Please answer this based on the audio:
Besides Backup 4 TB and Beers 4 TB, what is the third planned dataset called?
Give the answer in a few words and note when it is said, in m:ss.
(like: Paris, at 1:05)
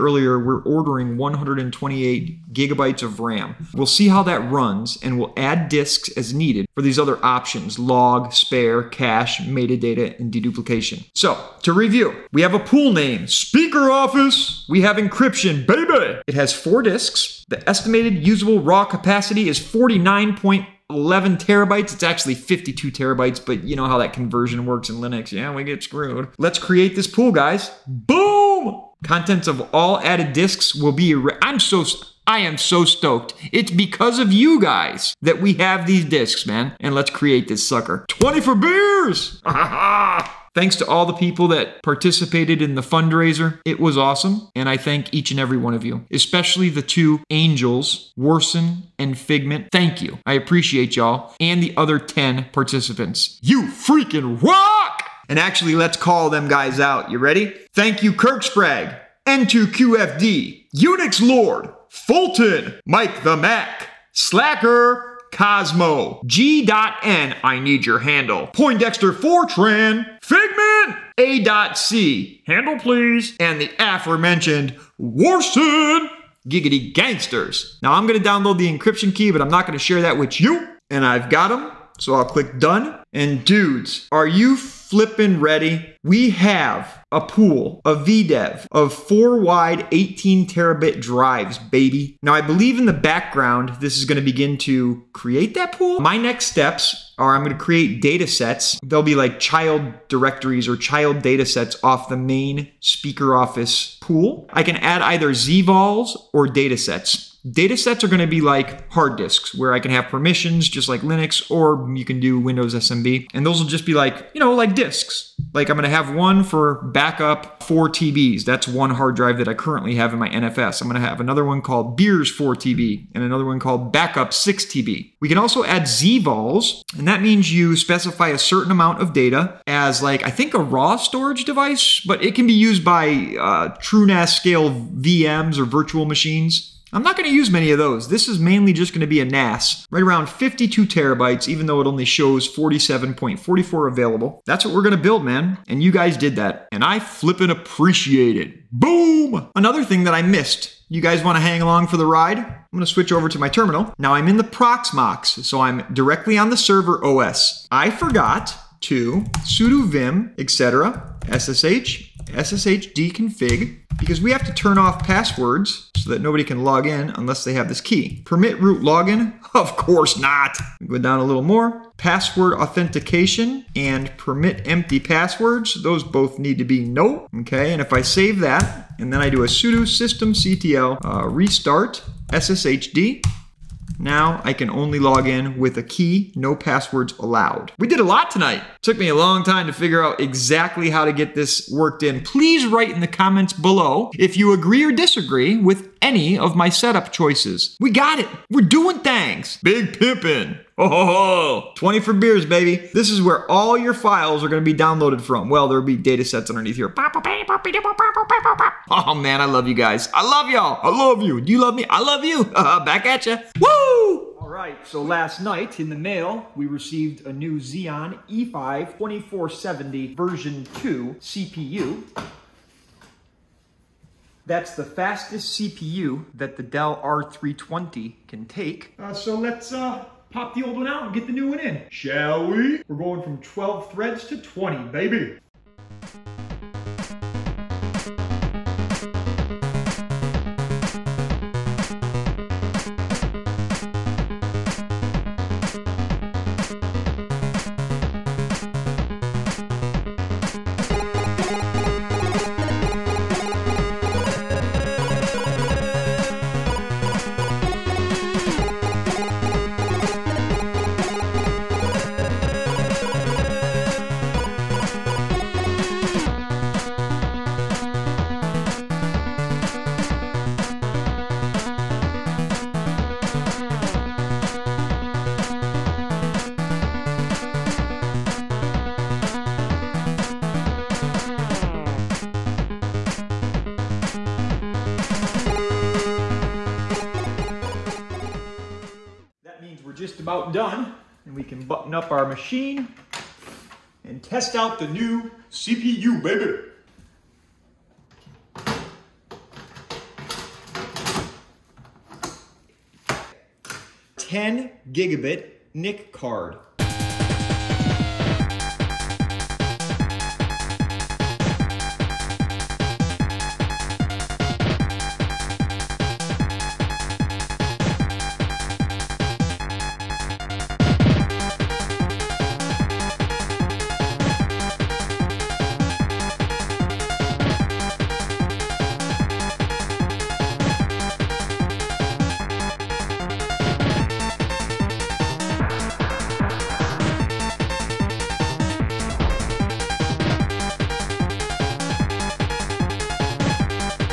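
Backup 6 TB, at 2:03.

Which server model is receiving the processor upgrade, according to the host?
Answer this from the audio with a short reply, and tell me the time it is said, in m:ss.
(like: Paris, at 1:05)
Dell R320, at 3:46.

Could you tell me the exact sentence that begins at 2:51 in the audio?
Password authentication and permit empty passwords.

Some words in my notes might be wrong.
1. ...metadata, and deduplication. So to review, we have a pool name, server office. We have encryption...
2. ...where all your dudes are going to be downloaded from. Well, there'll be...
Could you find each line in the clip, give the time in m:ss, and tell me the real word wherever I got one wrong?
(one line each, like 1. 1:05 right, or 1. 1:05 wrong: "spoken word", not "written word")
1. 0:09 wrong: "speaker", not "server"
2. 3:23 wrong: "files", not "dudes".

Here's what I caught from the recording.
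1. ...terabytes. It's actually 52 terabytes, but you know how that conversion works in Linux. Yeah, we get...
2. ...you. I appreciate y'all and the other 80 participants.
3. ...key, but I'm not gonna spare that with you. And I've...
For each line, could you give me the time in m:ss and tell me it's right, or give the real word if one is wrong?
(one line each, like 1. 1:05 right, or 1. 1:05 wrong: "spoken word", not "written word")
1. 0:21 right
2. 0:50 wrong: "10", not "80"
3. 1:19 wrong: "share", not "spare".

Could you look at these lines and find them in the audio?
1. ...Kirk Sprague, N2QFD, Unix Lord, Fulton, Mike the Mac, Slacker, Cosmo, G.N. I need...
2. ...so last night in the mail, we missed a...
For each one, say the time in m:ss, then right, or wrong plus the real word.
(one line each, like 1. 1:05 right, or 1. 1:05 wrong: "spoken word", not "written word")
1. 0:58 right
2. 3:34 wrong: "received", not "missed".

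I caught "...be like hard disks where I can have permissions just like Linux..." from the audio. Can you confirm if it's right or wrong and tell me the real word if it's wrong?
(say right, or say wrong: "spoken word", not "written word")
right.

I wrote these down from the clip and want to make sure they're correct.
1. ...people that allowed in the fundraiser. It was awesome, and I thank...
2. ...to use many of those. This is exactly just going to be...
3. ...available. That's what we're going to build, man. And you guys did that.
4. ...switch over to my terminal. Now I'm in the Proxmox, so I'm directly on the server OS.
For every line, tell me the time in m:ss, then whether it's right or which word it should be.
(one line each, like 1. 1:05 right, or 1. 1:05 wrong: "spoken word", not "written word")
1. 0:41 wrong: "participated", not "allowed"
2. 2:17 wrong: "mainly", not "exactly"
3. 2:23 right
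4. 2:32 right.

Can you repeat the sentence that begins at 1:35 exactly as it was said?
My next steps are I'm going to create data sets.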